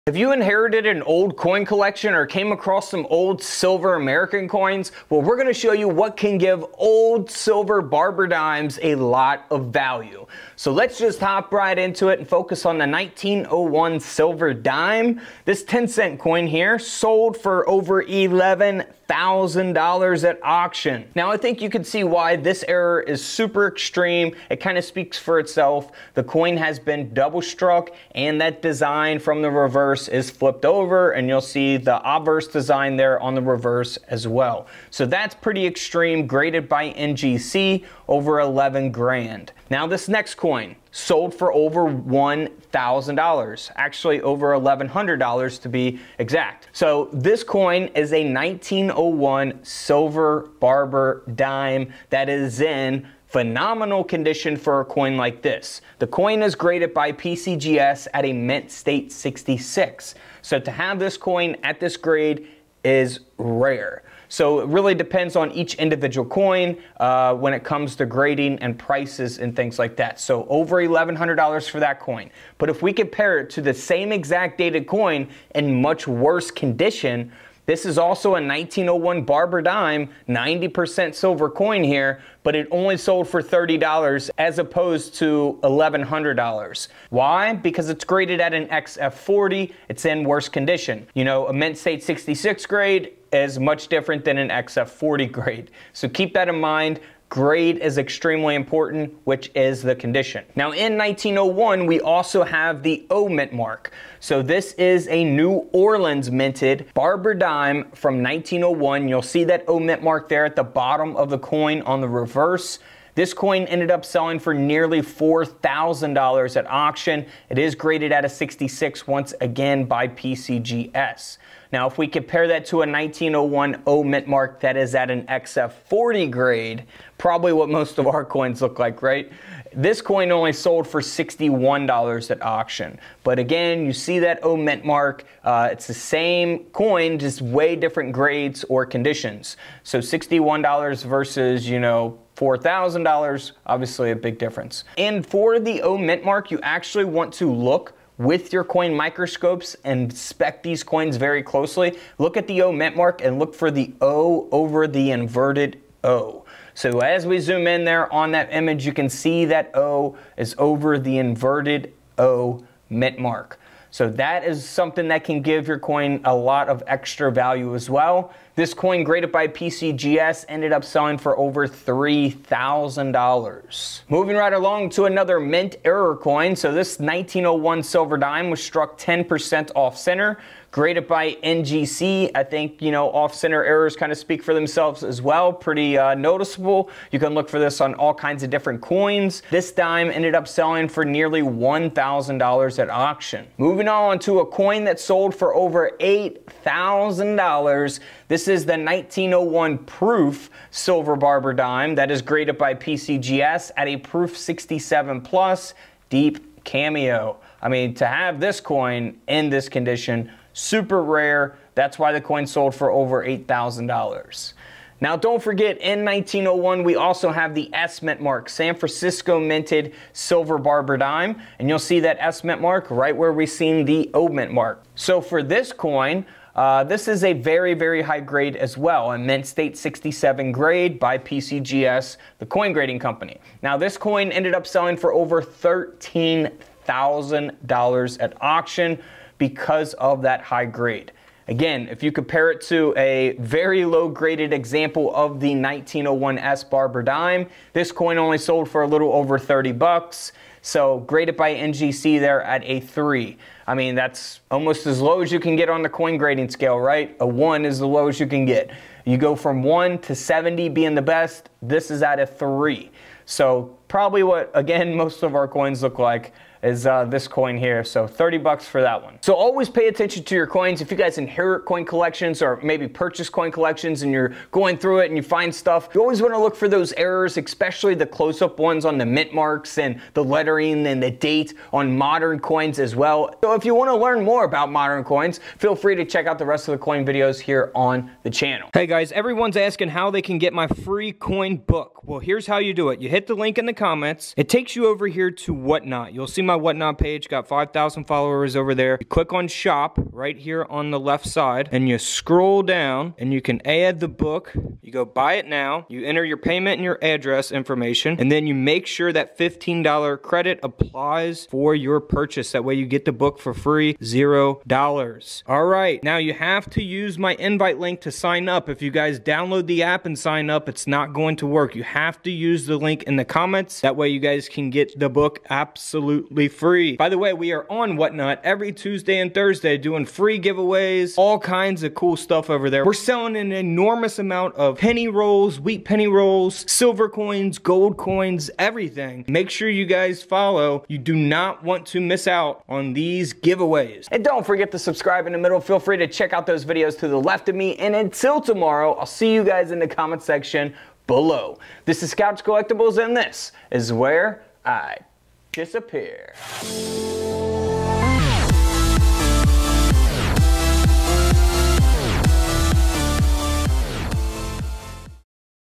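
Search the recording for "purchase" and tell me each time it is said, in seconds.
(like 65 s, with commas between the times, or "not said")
272 s, 312 s.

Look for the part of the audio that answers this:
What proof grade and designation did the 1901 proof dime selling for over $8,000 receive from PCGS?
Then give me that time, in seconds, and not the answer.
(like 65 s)
203 s.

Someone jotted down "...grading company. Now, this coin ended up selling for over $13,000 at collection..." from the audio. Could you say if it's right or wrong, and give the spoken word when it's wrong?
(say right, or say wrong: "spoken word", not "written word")
wrong: "auction", not "collection".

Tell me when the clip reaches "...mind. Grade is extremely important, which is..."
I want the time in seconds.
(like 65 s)
96 s.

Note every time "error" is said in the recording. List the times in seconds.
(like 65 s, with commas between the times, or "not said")
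22 s, 175 s, 183 s, 276 s.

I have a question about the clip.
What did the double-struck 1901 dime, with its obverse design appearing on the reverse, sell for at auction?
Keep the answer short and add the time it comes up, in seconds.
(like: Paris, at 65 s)
over $11,000, at 17 s.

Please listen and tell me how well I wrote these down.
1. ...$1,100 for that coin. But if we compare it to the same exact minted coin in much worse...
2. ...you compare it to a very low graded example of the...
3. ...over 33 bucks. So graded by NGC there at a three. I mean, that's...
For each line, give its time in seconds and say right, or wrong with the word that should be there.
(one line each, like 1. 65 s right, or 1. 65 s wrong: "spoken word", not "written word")
1. 70 s wrong: "dated", not "minted"
2. 242 s right
3. 249 s wrong: "30", not "33".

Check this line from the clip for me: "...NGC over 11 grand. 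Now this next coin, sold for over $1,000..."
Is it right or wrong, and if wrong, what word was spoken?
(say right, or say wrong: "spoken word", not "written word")
right.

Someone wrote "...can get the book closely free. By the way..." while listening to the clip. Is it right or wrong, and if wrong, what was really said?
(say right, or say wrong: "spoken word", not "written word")
wrong: "absolutely", not "closely".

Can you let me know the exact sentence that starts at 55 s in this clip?
The coin is graded by PCGS at a mint state 66.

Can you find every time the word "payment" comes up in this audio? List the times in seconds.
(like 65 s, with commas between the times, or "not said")
306 s.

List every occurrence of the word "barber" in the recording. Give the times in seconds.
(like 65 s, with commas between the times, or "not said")
7 s, 50 s, 79 s, 106 s, 201 s, 220 s, 246 s.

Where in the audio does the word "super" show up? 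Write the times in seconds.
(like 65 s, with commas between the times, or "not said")
23 s, 210 s.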